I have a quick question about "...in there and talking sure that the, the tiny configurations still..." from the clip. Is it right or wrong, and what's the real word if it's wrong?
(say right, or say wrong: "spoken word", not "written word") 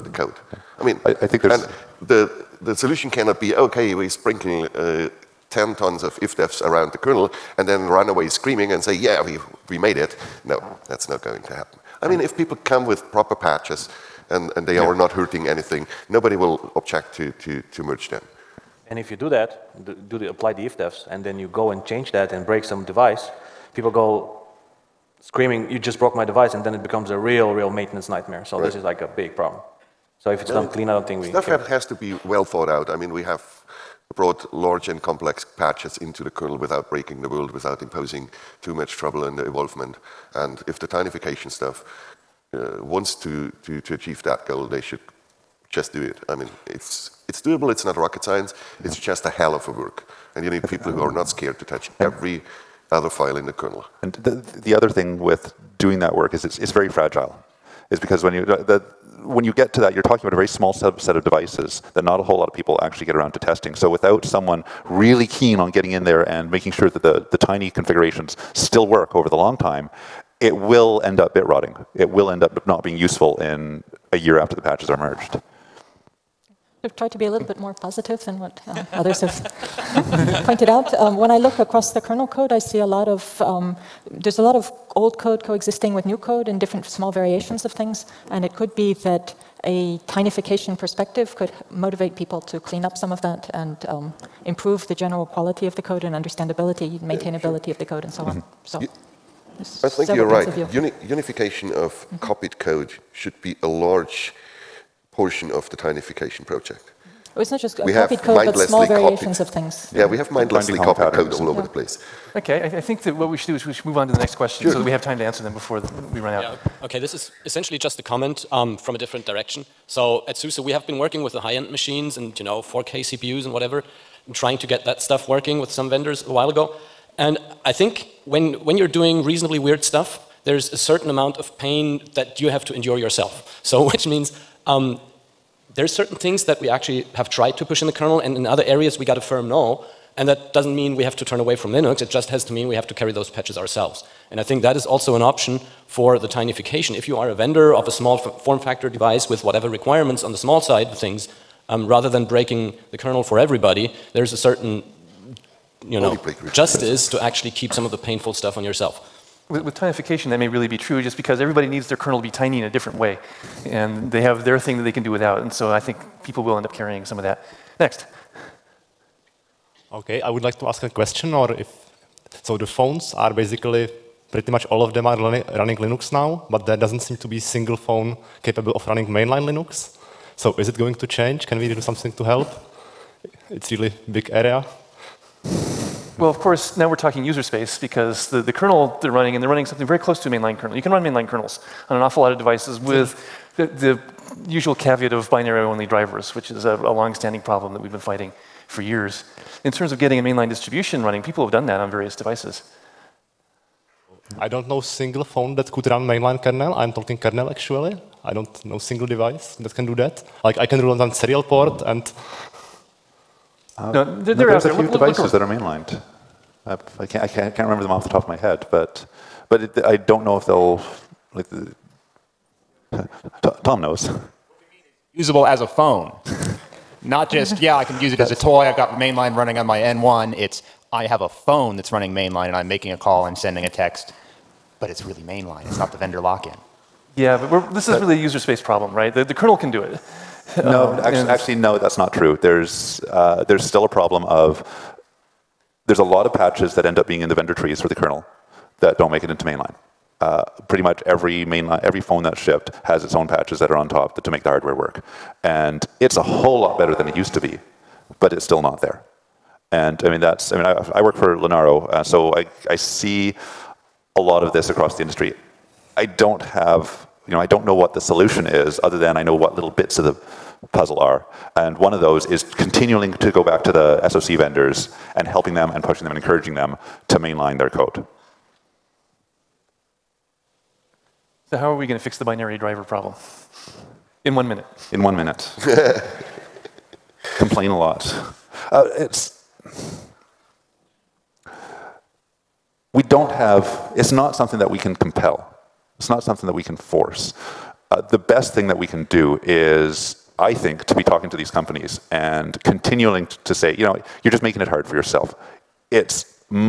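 wrong: "making", not "talking".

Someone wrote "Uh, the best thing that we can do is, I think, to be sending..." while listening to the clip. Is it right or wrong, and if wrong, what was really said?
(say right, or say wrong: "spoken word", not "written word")
wrong: "talking", not "sending".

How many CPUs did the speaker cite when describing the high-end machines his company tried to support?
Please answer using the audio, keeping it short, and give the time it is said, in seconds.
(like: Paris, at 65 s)
4K, at 122 s.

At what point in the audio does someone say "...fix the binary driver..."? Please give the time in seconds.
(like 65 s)
282 s.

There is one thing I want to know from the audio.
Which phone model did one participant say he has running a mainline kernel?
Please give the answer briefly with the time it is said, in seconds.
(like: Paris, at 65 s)
N1, at 229 s.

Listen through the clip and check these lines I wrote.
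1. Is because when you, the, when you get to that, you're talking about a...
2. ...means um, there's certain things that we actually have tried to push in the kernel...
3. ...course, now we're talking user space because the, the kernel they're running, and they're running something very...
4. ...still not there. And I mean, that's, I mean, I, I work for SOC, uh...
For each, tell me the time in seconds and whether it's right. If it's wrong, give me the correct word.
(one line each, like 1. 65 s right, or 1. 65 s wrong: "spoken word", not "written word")
1. 57 s right
2. 134 s right
3. 186 s right
4. 258 s wrong: "Linaro", not "SOC".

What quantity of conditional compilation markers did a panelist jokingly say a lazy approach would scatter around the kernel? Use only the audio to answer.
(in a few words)
10 tons.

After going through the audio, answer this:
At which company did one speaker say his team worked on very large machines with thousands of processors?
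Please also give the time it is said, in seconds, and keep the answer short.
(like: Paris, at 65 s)
SUSE, at 120 s.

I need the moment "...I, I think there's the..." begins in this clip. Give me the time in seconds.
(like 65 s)
1 s.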